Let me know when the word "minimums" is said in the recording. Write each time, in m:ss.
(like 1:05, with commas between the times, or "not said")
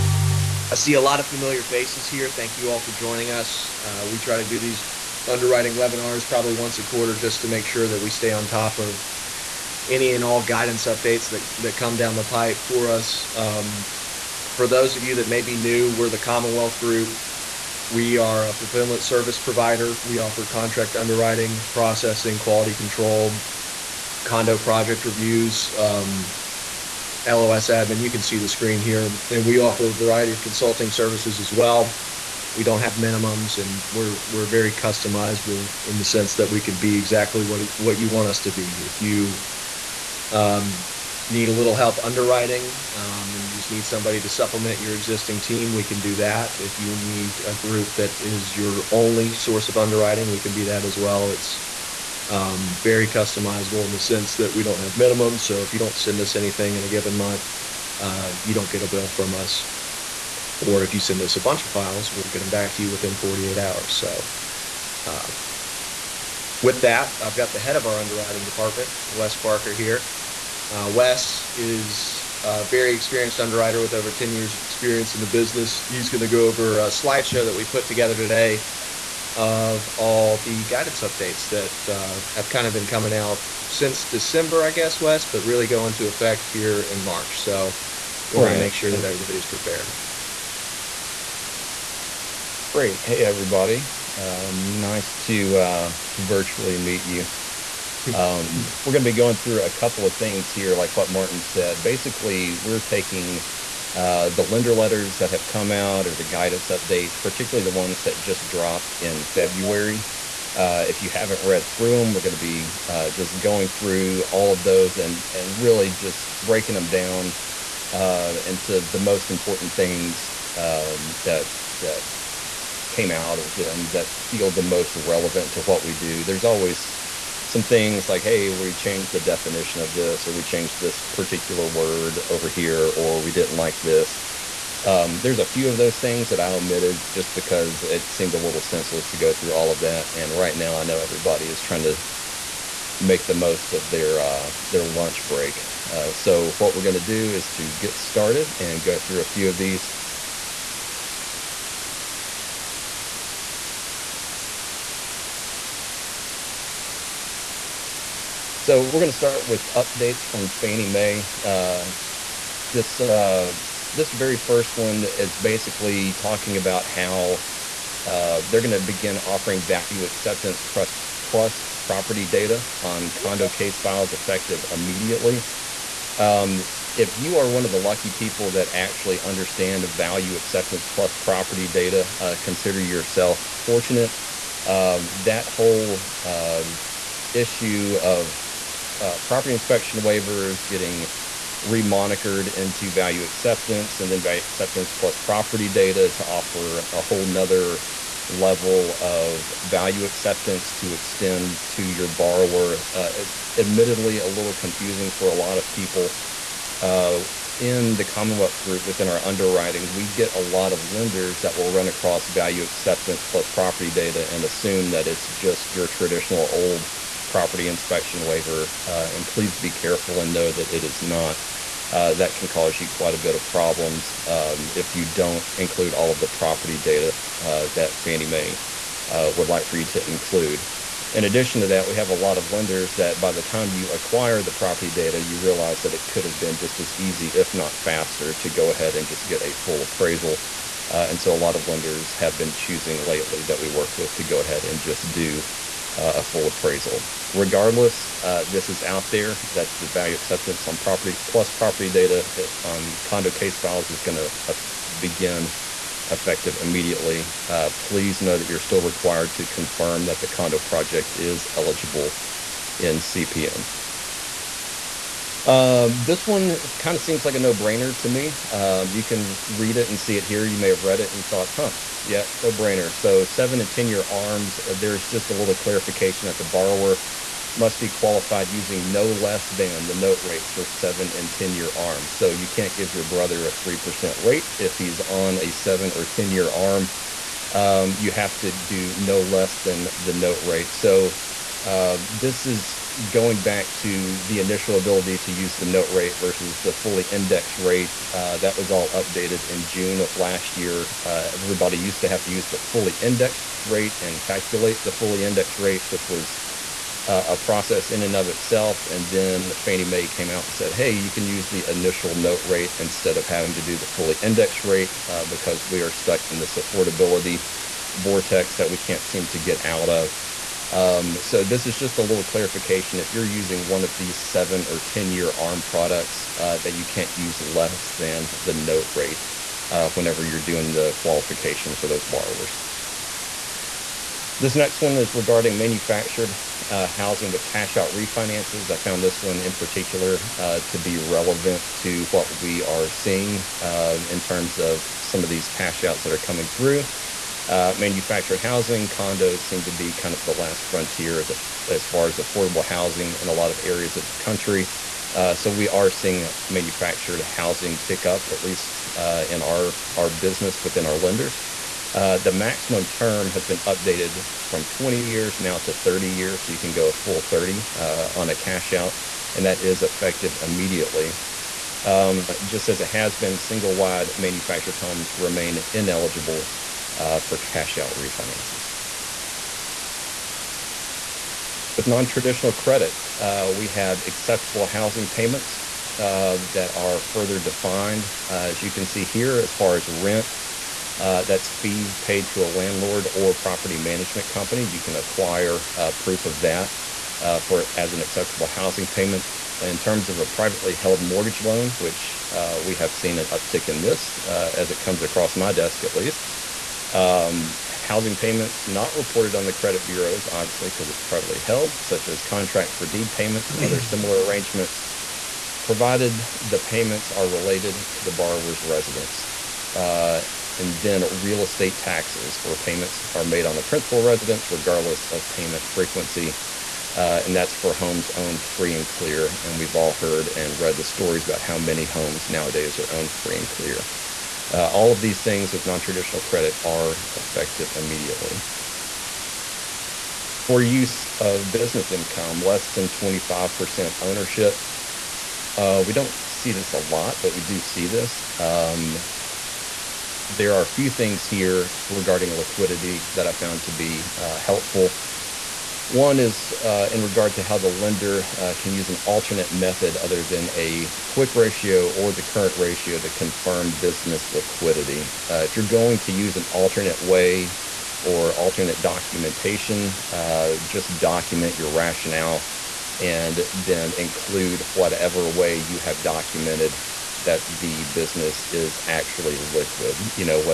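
0:32, 0:54.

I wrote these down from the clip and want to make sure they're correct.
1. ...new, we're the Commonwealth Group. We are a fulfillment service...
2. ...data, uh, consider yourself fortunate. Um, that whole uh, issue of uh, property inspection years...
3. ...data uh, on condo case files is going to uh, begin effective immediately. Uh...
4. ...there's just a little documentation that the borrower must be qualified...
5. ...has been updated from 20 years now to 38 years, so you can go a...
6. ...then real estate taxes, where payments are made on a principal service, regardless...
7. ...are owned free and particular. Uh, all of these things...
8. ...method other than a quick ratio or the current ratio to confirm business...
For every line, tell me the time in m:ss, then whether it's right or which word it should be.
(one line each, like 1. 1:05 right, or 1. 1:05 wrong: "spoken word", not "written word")
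1. 0:15 right
2. 3:01 wrong: "waivers", not "years"
3. 4:11 right
4. 4:34 wrong: "clarification", not "documentation"
5. 6:03 wrong: "30", not "38"
6. 7:00 wrong: "residence", not "service"
7. 7:12 wrong: "clear", not "particular"
8. 7:39 right.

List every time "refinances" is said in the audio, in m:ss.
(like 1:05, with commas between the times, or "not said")
5:37, 6:17.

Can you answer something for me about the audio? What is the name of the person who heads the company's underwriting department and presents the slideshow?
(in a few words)
Wes Parker.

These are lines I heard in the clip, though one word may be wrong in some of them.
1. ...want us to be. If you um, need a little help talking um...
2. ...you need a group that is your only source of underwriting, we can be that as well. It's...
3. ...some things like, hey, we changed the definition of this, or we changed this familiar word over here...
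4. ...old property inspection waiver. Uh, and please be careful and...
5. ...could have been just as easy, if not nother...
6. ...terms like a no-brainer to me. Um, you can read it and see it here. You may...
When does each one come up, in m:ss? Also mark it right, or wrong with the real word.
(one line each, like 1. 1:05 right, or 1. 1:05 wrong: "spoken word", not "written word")
1. 0:38 wrong: "underwriting", not "talking"
2. 0:46 right
3. 2:07 wrong: "particular", not "familiar"
4. 3:36 right
5. 3:56 wrong: "faster", not "nother"
6. 4:27 wrong: "seems", not "terms".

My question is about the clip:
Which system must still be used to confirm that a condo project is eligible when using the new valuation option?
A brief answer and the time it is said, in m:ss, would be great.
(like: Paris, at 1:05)
CPM, at 4:22.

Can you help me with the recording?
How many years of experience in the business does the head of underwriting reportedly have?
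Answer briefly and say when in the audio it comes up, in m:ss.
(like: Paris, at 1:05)
over 10 years, at 1:13.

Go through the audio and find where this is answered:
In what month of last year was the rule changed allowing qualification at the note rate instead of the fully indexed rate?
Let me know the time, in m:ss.
4:59.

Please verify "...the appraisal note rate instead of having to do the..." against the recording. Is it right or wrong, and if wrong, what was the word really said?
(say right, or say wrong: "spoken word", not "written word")
wrong: "initial", not "appraisal".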